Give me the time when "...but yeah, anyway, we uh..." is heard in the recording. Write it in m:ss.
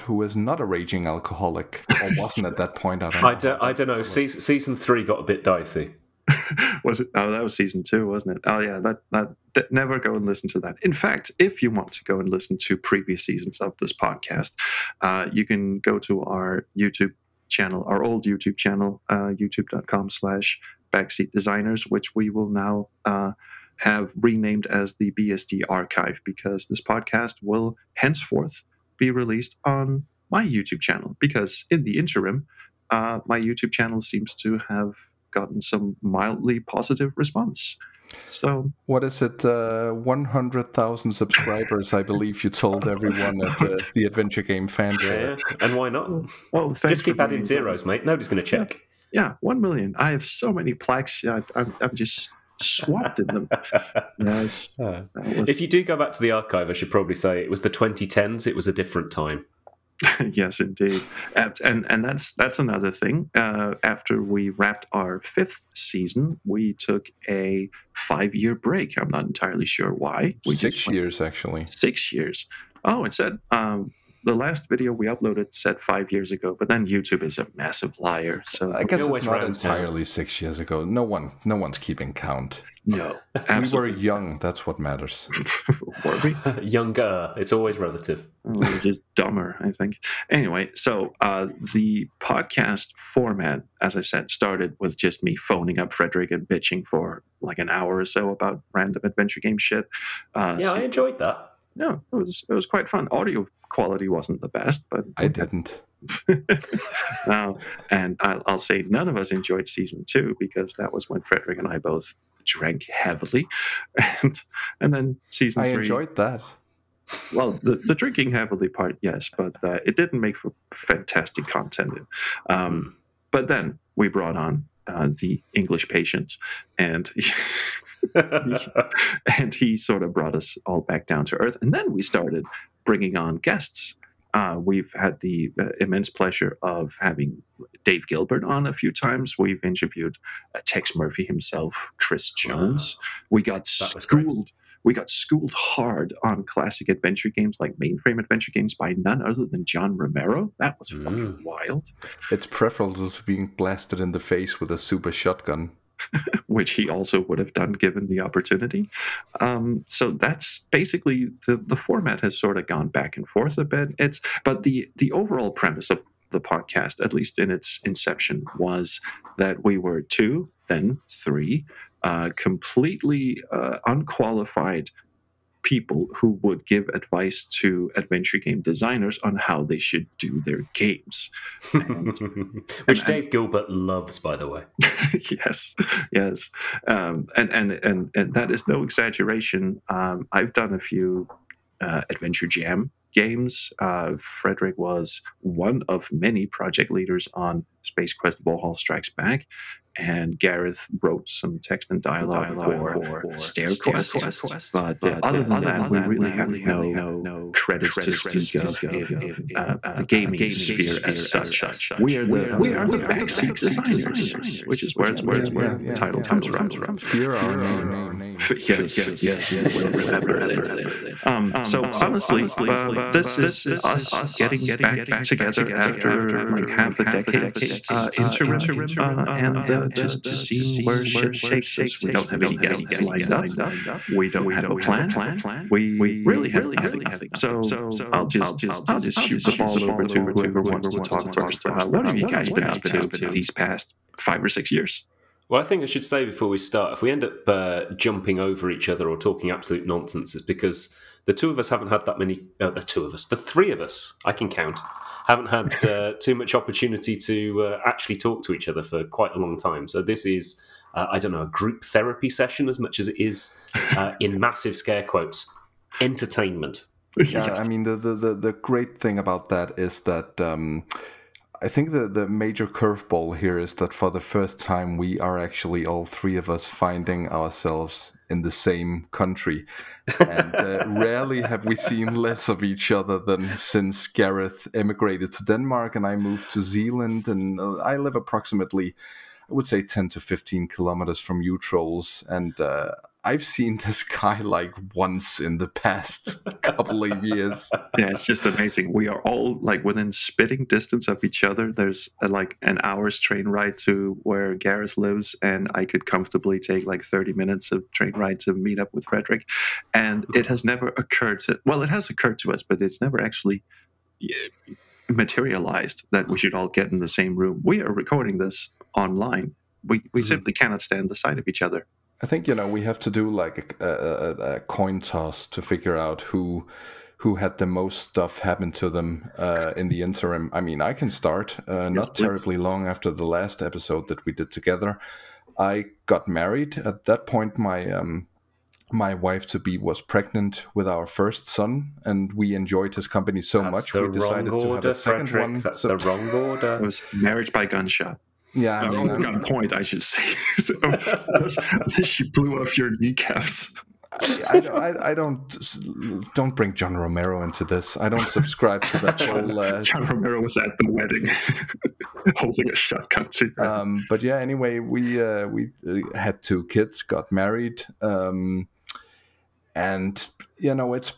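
6:04.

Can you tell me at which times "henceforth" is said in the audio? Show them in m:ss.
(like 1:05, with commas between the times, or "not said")
0:27.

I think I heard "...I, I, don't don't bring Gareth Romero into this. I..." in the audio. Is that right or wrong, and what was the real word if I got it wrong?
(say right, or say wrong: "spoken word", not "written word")
wrong: "John", not "Gareth".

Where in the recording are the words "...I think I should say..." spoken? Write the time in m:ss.
4:05.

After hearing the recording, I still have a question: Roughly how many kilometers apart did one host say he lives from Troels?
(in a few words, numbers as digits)
10 to 15.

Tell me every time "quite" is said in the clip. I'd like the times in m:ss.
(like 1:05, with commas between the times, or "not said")
1:42, 4:19.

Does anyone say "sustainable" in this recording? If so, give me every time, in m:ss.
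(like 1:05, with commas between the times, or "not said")
not said.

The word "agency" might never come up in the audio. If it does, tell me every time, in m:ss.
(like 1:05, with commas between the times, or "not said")
not said.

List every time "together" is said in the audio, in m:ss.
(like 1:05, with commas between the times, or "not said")
3:45, 5:34.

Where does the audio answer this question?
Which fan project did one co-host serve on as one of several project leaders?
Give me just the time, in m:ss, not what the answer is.
3:17.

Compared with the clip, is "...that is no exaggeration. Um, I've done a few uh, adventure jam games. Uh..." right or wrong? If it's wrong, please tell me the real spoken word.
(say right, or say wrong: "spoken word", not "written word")
right.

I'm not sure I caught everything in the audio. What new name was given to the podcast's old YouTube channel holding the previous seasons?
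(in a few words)
BSD archive.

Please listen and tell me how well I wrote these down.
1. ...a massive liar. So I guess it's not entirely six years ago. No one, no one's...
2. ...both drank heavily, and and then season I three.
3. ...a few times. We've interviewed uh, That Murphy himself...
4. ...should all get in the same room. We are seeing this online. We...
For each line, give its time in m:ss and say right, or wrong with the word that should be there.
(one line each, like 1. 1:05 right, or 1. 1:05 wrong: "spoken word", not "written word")
1. 1:17 right
2. 1:51 right
3. 2:18 wrong: "Tex", not "That"
4. 5:16 wrong: "recording", not "seeing".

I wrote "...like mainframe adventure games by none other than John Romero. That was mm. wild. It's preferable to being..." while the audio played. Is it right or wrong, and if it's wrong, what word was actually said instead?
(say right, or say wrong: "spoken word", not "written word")
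right.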